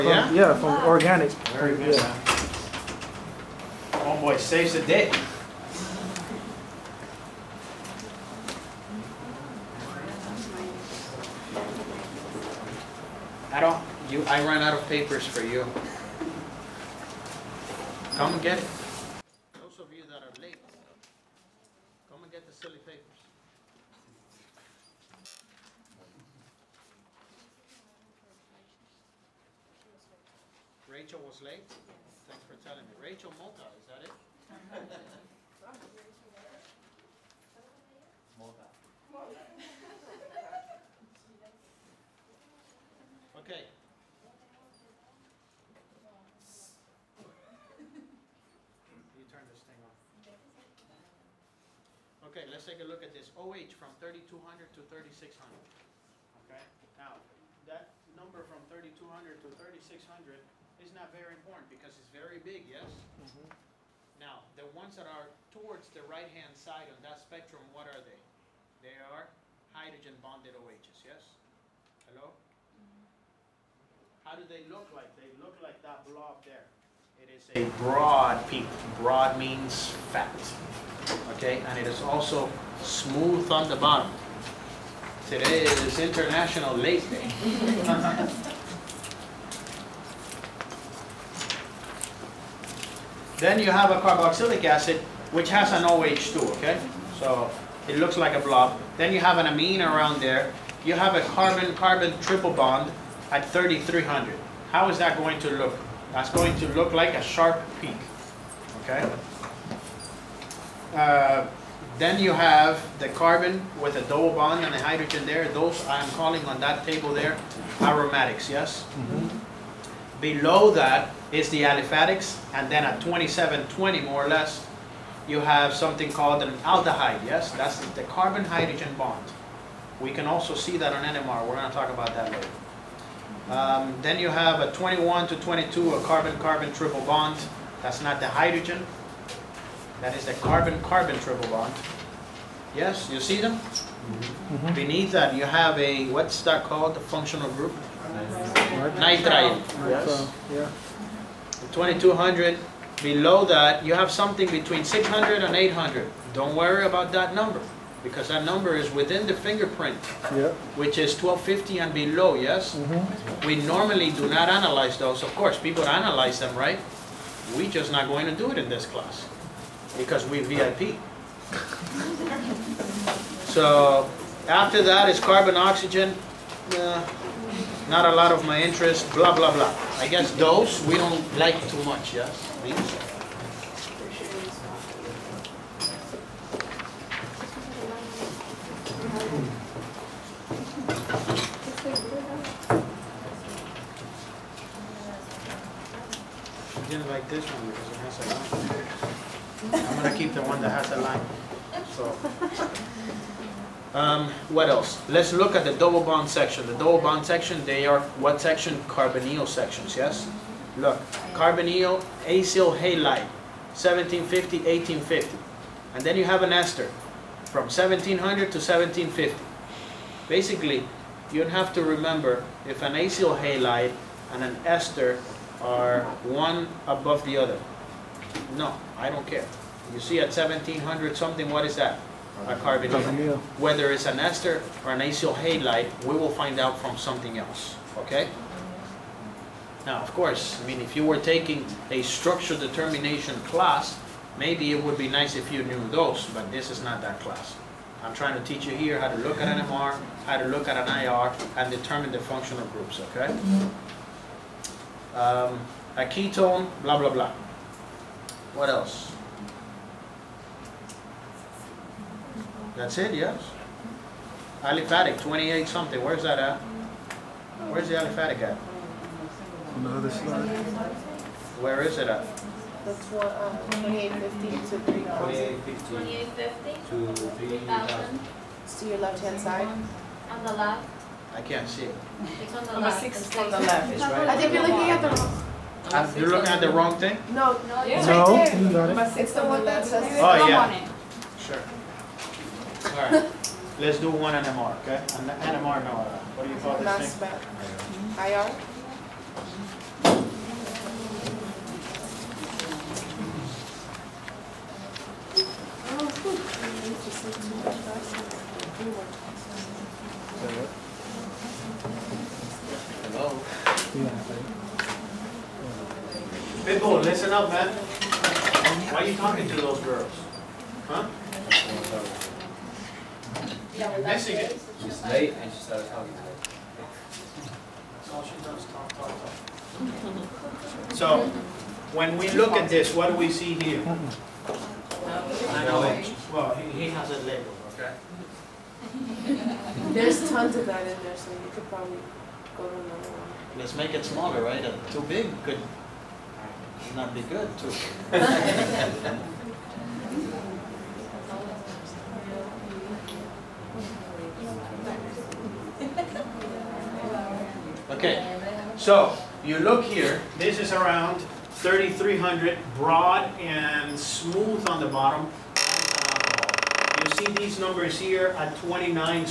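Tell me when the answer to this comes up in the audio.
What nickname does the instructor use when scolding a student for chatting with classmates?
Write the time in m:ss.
5:16.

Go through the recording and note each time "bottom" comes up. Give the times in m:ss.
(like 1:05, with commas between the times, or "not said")
1:23, 6:04.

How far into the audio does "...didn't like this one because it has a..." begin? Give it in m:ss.
3:16.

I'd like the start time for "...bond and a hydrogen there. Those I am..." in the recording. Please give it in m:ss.
1:54.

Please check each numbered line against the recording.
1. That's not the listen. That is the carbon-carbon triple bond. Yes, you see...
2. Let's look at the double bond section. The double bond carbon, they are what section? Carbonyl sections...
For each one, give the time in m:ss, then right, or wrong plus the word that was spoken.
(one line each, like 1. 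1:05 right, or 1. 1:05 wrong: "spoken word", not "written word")
1. 2:17 wrong: "hydrogen", not "listen"
2. 3:25 wrong: "section", not "carbon".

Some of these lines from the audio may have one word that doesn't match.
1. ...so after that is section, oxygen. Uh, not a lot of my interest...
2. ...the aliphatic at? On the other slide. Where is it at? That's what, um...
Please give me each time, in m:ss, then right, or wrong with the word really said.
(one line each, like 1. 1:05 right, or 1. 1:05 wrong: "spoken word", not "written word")
1. 2:53 wrong: "carbon", not "section"
2. 4:27 right.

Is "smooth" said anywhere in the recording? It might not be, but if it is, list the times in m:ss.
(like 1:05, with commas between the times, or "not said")
1:22, 6:03.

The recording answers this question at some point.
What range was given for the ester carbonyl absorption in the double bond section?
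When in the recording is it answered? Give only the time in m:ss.
3:37.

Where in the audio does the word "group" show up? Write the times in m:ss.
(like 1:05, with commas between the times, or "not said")
2:27, 4:12.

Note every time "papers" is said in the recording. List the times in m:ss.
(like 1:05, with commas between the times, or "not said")
0:14, 0:22.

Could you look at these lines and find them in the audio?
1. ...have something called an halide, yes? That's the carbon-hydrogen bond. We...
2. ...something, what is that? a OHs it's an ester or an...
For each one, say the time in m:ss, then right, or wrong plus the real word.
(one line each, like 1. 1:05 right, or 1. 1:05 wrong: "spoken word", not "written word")
1. 2:05 wrong: "aldehyde", not "halide"
2. 3:51 wrong: "Whether", not "OHs".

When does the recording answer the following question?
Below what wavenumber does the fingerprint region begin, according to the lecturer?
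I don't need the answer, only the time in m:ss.
2:41.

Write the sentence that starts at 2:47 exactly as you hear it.
we just not going to do it in this class because we VIP.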